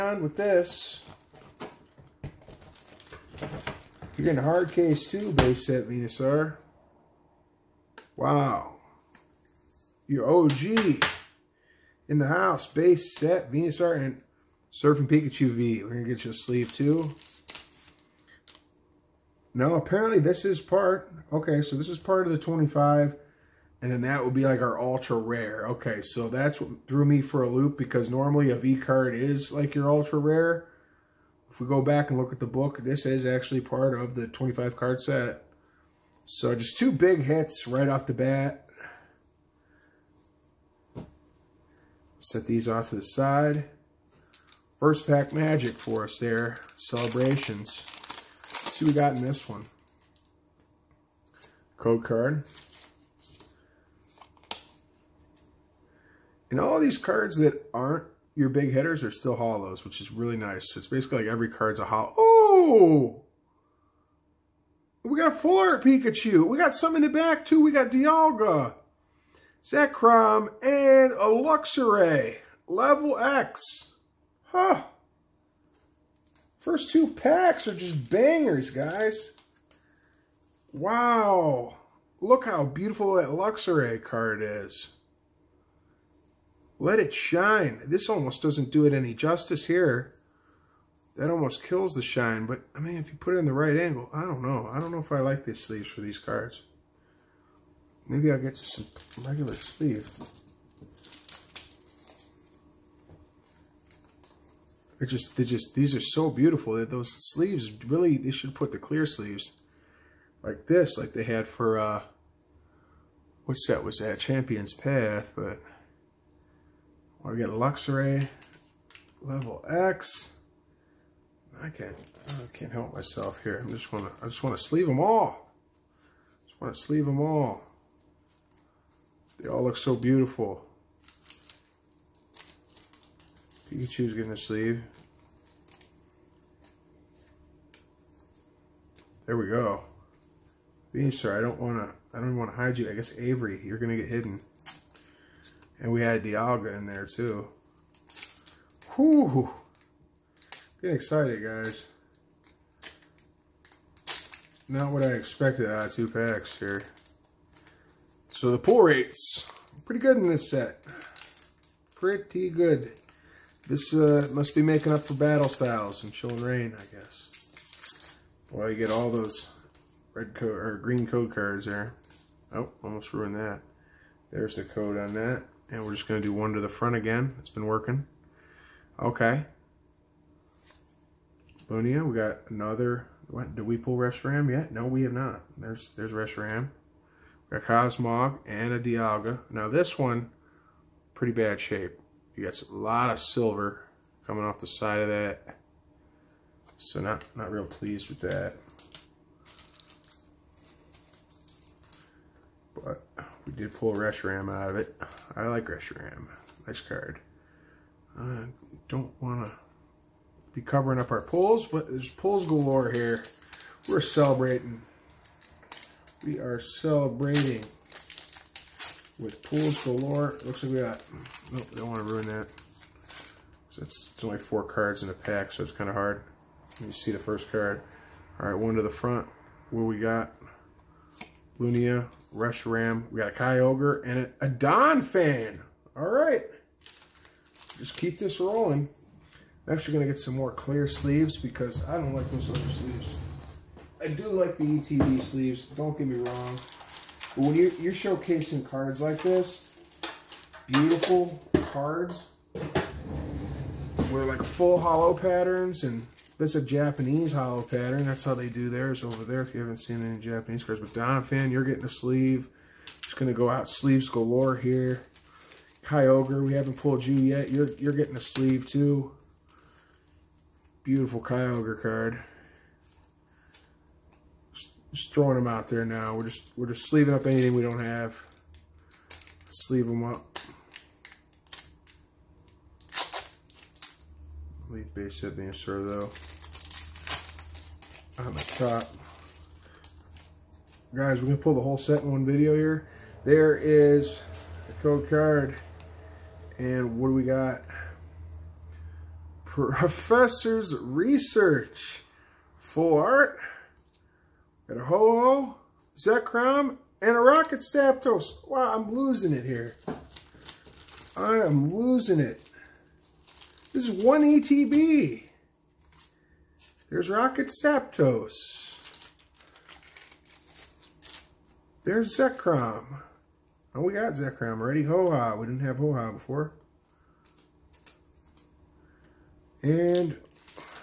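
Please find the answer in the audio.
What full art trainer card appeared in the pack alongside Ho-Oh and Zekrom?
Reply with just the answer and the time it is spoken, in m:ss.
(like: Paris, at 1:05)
Professor's Research, at 4:59.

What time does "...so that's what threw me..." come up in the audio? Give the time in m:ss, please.
0:26.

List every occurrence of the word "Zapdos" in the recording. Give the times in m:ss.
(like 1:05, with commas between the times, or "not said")
5:07, 5:17.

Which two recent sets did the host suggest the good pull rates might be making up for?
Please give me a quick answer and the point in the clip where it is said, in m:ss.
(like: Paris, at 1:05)
Battle Styles and Chilling Reign, at 2:45.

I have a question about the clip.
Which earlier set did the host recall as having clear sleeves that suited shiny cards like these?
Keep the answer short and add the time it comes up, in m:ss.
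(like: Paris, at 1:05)
Champion's Path, at 1:54.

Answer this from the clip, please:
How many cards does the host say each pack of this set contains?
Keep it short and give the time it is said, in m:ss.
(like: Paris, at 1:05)
4, at 3:44.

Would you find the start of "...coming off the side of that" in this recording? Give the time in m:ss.
3:14.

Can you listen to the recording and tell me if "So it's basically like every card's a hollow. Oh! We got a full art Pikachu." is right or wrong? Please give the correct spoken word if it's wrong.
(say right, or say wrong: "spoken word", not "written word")
right.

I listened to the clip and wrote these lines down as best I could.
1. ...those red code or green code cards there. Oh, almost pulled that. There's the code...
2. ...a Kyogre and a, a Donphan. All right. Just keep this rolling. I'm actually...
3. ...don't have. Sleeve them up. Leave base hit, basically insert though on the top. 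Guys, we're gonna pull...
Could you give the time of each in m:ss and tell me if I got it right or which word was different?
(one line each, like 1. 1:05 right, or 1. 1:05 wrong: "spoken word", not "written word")
1. 2:49 wrong: "ruined", not "pulled"
2. 3:53 right
3. 4:37 right.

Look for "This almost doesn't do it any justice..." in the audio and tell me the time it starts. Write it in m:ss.
1:27.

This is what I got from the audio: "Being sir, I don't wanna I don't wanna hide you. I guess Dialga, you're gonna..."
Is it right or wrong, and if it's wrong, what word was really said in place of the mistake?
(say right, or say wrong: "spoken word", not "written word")
wrong: "Avery", not "Dialga".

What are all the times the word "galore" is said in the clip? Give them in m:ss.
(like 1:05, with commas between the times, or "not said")
3:32, 3:39, 4:24.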